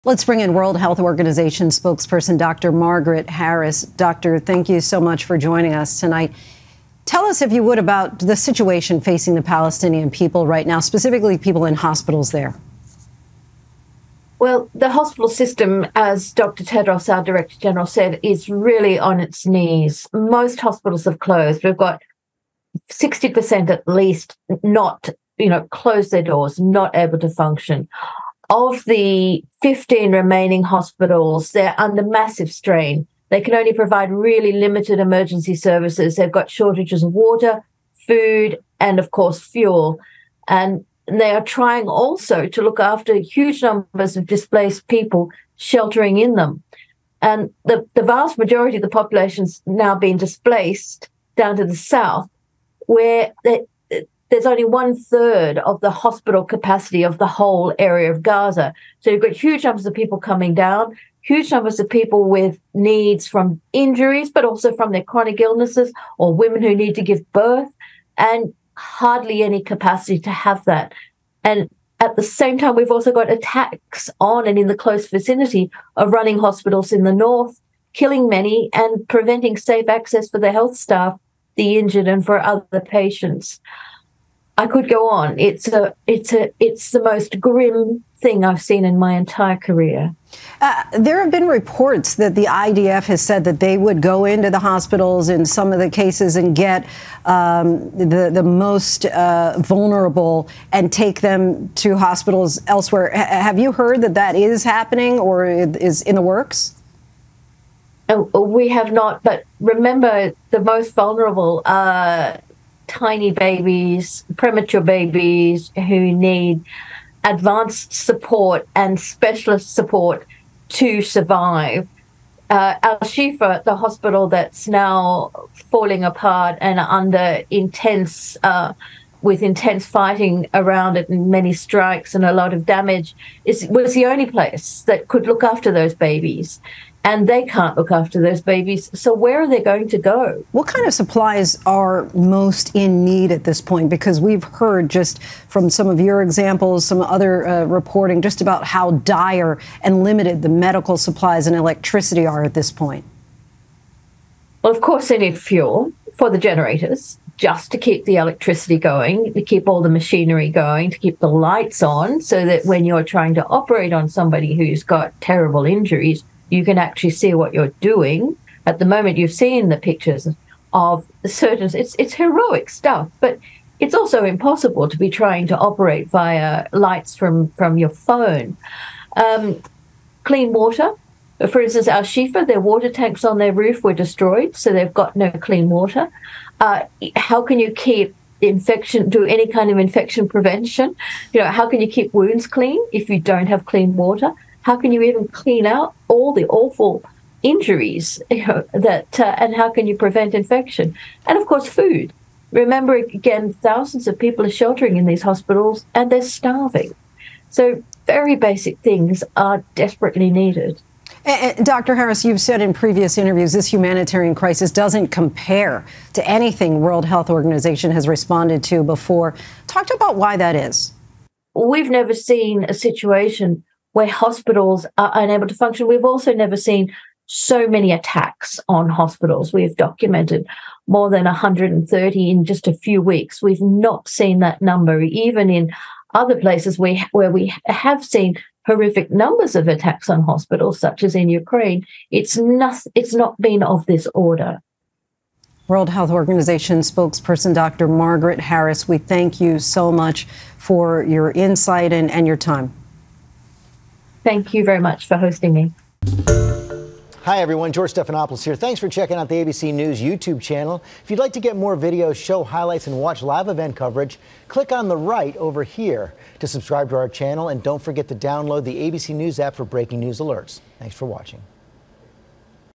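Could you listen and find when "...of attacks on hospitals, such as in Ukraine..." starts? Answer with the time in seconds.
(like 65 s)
239 s.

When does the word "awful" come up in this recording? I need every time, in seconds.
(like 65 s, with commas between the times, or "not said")
196 s.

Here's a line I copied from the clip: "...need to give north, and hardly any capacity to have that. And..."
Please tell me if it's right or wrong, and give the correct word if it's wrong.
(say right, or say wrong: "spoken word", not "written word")
wrong: "birth", not "north".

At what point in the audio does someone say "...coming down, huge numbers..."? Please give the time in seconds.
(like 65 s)
60 s.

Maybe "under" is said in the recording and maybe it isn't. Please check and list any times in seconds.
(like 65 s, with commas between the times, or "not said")
31 s, 126 s.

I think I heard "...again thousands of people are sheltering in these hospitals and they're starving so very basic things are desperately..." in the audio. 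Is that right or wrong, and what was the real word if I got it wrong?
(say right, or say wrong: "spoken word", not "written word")
right.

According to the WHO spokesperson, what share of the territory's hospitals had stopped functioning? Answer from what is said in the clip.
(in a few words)
60%.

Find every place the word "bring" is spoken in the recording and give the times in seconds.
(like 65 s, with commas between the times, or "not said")
0 s.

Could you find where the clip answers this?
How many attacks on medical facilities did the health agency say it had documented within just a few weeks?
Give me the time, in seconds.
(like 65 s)
230 s.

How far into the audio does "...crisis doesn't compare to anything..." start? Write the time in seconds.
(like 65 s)
214 s.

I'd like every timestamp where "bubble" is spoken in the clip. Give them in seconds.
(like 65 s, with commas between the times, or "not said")
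not said.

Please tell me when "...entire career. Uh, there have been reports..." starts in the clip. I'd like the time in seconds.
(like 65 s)
89 s.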